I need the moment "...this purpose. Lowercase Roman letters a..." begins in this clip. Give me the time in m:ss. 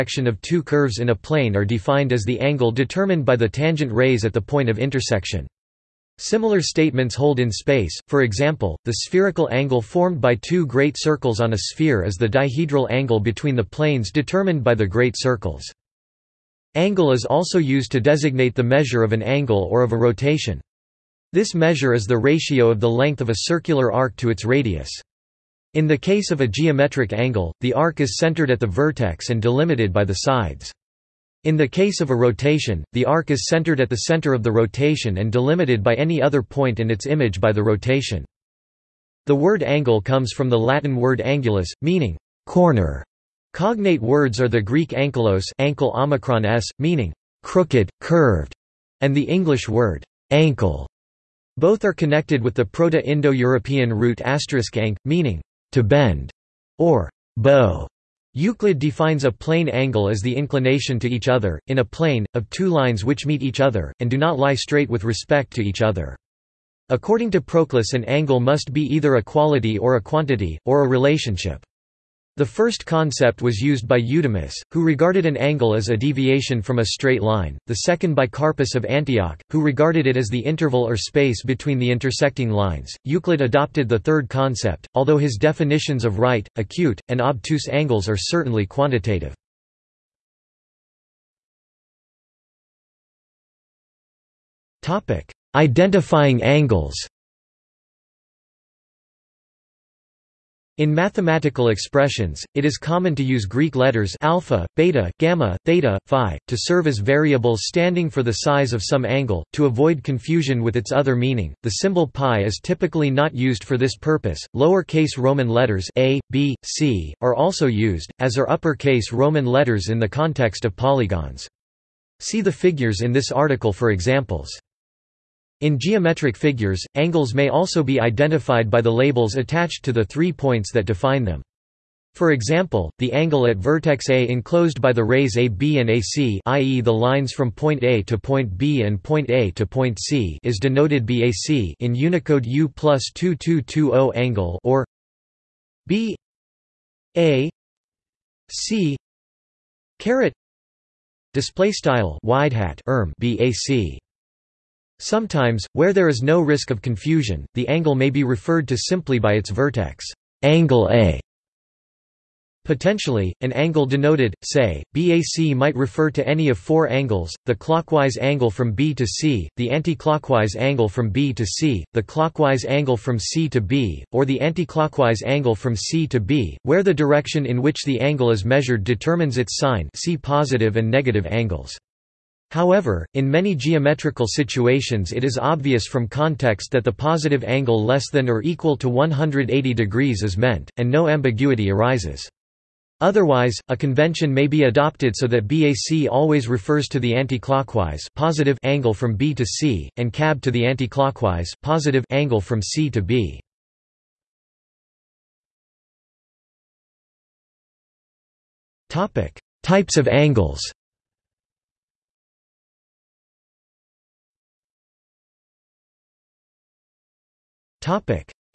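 1:53.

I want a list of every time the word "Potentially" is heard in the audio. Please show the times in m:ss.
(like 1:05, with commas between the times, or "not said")
2:42.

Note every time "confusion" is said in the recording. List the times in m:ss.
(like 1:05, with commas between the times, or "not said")
1:50, 2:36.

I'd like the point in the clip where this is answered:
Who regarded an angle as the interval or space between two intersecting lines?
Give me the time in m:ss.
1:18.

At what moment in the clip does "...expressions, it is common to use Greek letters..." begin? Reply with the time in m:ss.
1:41.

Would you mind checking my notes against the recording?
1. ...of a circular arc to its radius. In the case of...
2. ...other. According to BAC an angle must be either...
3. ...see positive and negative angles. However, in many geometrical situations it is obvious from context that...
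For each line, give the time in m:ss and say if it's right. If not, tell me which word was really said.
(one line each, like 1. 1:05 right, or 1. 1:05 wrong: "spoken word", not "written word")
1. 0:23 right
2. 1:05 wrong: "Proclus", not "BAC"
3. 2:59 right.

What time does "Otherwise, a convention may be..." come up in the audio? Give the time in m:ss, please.
3:12.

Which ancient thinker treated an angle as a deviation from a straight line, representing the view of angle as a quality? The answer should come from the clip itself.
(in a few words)
Eudemus.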